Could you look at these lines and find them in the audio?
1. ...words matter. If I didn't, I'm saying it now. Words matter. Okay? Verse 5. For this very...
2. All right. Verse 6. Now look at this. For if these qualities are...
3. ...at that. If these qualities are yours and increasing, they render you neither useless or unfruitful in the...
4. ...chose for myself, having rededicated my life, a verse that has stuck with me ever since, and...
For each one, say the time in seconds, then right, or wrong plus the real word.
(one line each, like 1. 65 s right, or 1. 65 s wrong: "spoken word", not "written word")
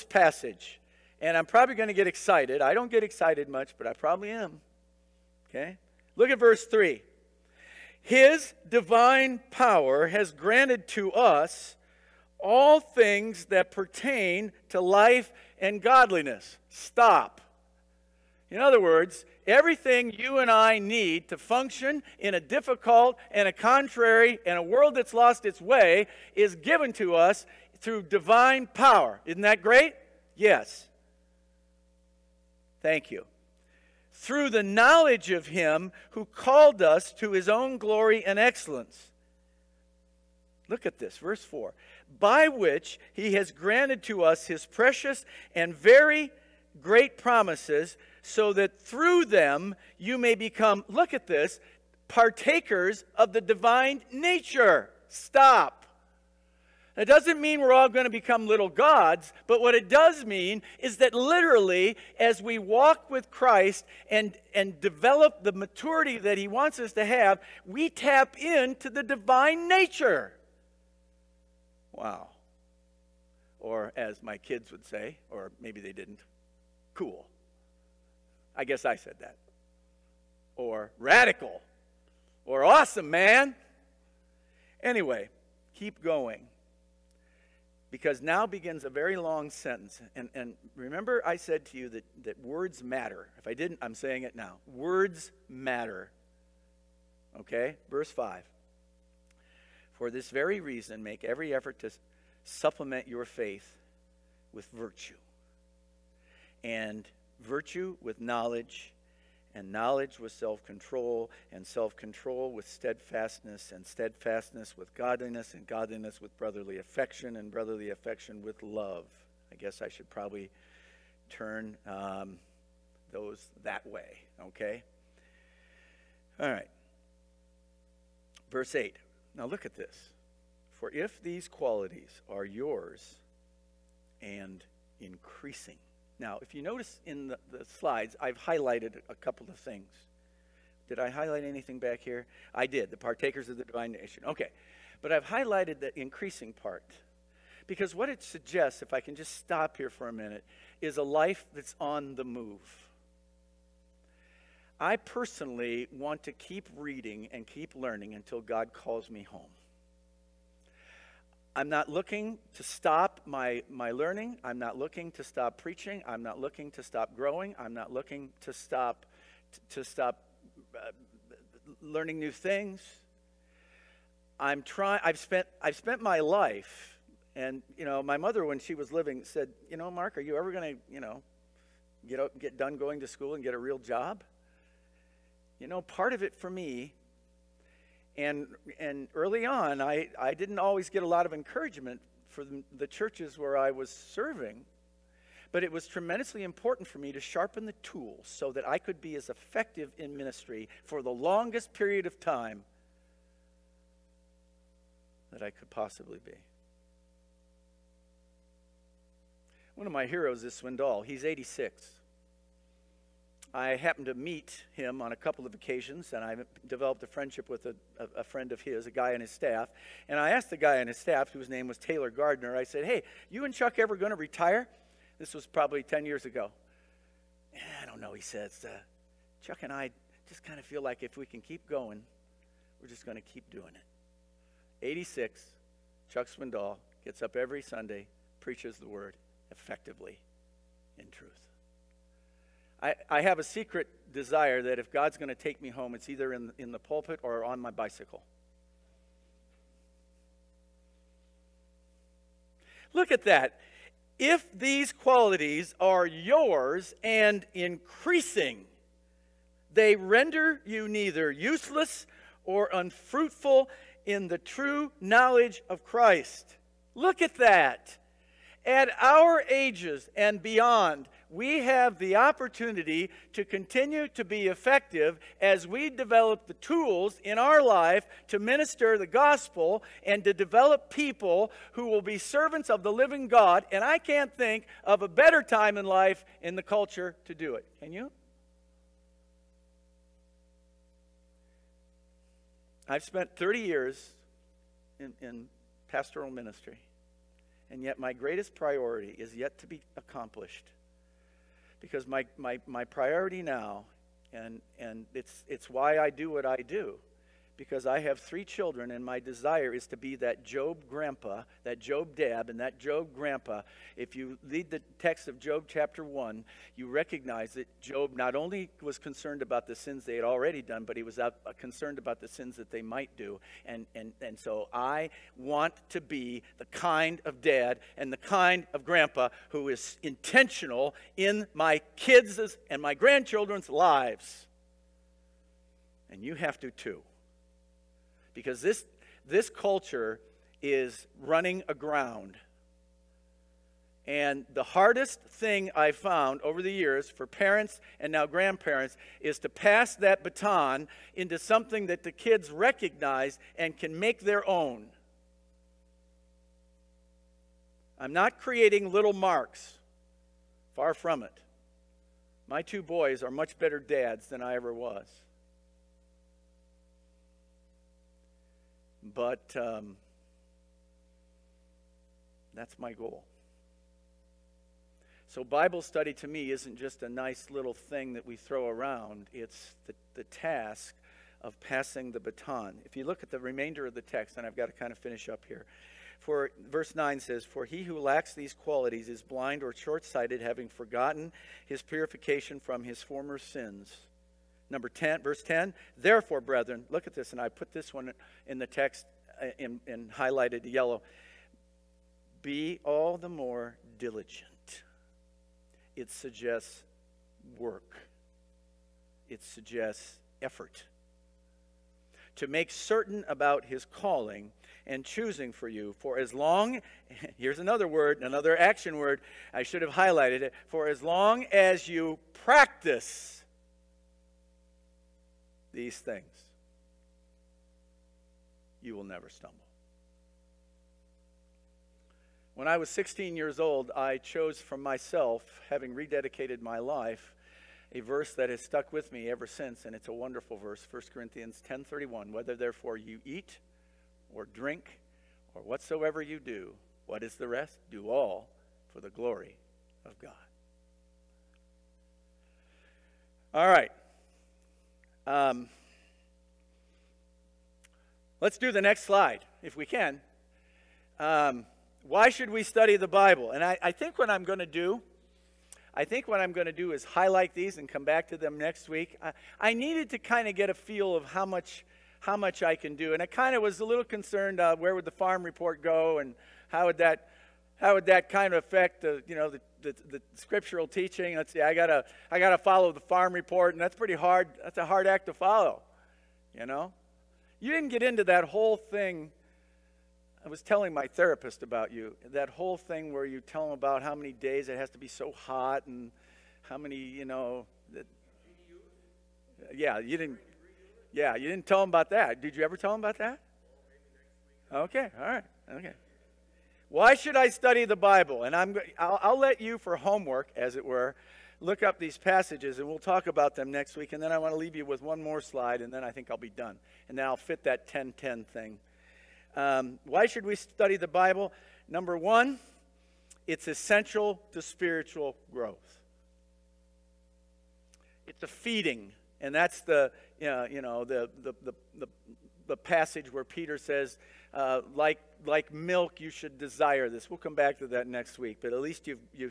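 1. 92 s right
2. 126 s wrong: "8", not "6"
3. 253 s right
4. 434 s right.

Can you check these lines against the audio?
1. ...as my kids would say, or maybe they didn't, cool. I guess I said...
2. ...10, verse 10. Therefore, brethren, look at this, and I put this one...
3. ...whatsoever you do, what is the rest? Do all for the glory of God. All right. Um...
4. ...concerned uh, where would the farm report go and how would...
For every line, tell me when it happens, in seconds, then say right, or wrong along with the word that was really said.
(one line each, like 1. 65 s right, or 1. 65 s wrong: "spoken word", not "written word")
1. 73 s right
2. 394 s right
3. 445 s right
4. 474 s right.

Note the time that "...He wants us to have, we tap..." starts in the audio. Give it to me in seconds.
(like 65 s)
66 s.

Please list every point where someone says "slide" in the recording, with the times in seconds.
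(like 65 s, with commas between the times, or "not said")
137 s, 459 s, 515 s.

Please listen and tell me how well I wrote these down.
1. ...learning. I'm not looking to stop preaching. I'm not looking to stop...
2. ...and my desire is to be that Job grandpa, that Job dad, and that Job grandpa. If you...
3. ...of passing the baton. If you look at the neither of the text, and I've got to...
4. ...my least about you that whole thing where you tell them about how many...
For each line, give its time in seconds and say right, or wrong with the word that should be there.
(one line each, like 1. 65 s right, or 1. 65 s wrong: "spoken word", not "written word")
1. 163 s right
2. 308 s right
3. 381 s wrong: "remainder", not "neither"
4. 490 s wrong: "therapist", not "least".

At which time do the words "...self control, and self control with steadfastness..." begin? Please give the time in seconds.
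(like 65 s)
110 s.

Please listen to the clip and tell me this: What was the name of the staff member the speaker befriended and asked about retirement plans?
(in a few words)
Taylor Gardner.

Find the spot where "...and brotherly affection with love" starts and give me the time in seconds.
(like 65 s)
117 s.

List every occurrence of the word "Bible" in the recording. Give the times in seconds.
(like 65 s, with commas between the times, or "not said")
375 s, 463 s, 507 s, 521 s.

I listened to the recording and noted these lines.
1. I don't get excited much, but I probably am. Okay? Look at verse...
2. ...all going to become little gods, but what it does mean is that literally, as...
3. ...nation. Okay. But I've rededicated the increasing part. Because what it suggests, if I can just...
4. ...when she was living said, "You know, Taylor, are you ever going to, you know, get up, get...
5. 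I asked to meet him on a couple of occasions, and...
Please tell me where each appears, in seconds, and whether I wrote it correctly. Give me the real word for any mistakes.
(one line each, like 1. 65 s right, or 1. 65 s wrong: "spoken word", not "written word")
1. 2 s right
2. 57 s right
3. 143 s wrong: "highlighted", not "rededicated"
4. 178 s wrong: "Mark", not "Taylor"
5. 213 s wrong: "happened", not "asked".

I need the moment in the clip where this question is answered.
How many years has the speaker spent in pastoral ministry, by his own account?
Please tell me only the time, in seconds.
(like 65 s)
293 s.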